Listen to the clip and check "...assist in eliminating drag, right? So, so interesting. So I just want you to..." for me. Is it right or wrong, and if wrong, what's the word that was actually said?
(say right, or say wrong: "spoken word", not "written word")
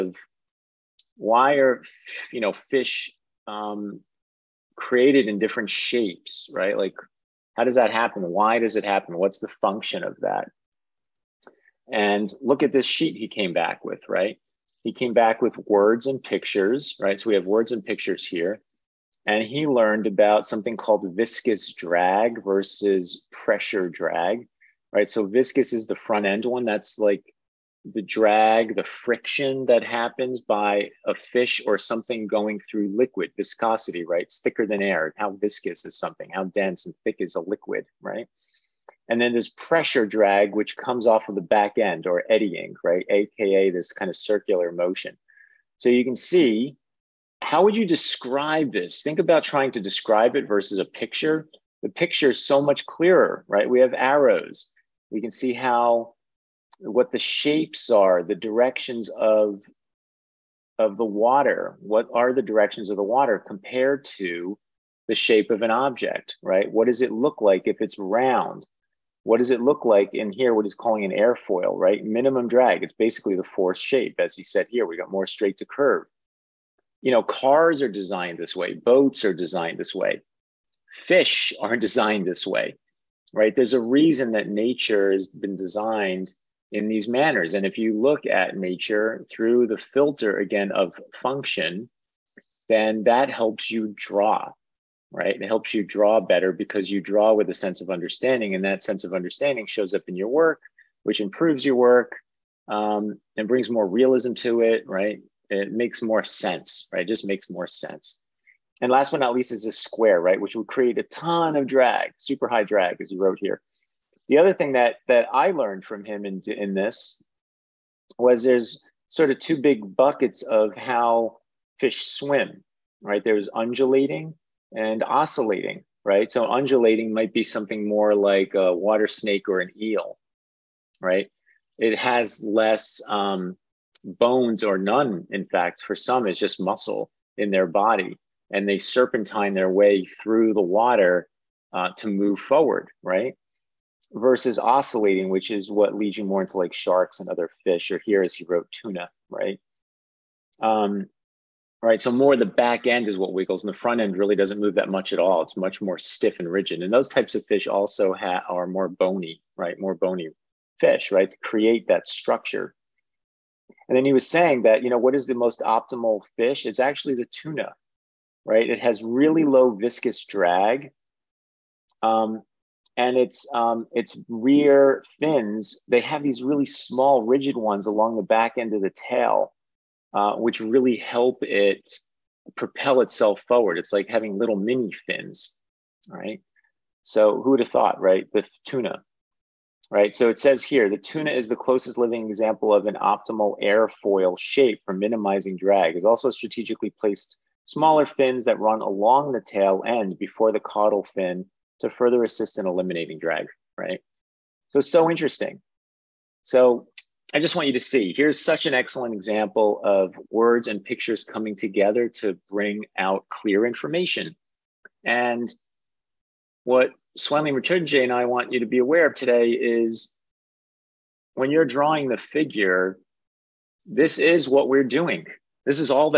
right.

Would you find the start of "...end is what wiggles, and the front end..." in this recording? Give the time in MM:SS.
02:32.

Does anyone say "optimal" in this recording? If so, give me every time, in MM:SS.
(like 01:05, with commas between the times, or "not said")
02:45, 03:13.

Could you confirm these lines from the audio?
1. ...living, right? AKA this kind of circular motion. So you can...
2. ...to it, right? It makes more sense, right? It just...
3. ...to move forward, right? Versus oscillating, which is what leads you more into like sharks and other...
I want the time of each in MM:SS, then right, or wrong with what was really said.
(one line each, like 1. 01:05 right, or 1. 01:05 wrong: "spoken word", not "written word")
1. 00:42 wrong: "eddying", not "living"
2. 01:44 right
3. 02:21 right.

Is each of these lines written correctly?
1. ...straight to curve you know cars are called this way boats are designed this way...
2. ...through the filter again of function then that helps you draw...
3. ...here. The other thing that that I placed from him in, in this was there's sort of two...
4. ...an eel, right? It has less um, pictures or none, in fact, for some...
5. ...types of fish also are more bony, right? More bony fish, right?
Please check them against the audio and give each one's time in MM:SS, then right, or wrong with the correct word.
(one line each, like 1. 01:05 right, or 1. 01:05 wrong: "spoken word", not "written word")
1. 01:15 wrong: "designed", not "called"
2. 01:29 right
3. 01:53 wrong: "learned", not "placed"
4. 02:09 wrong: "bones", not "pictures"
5. 02:37 right.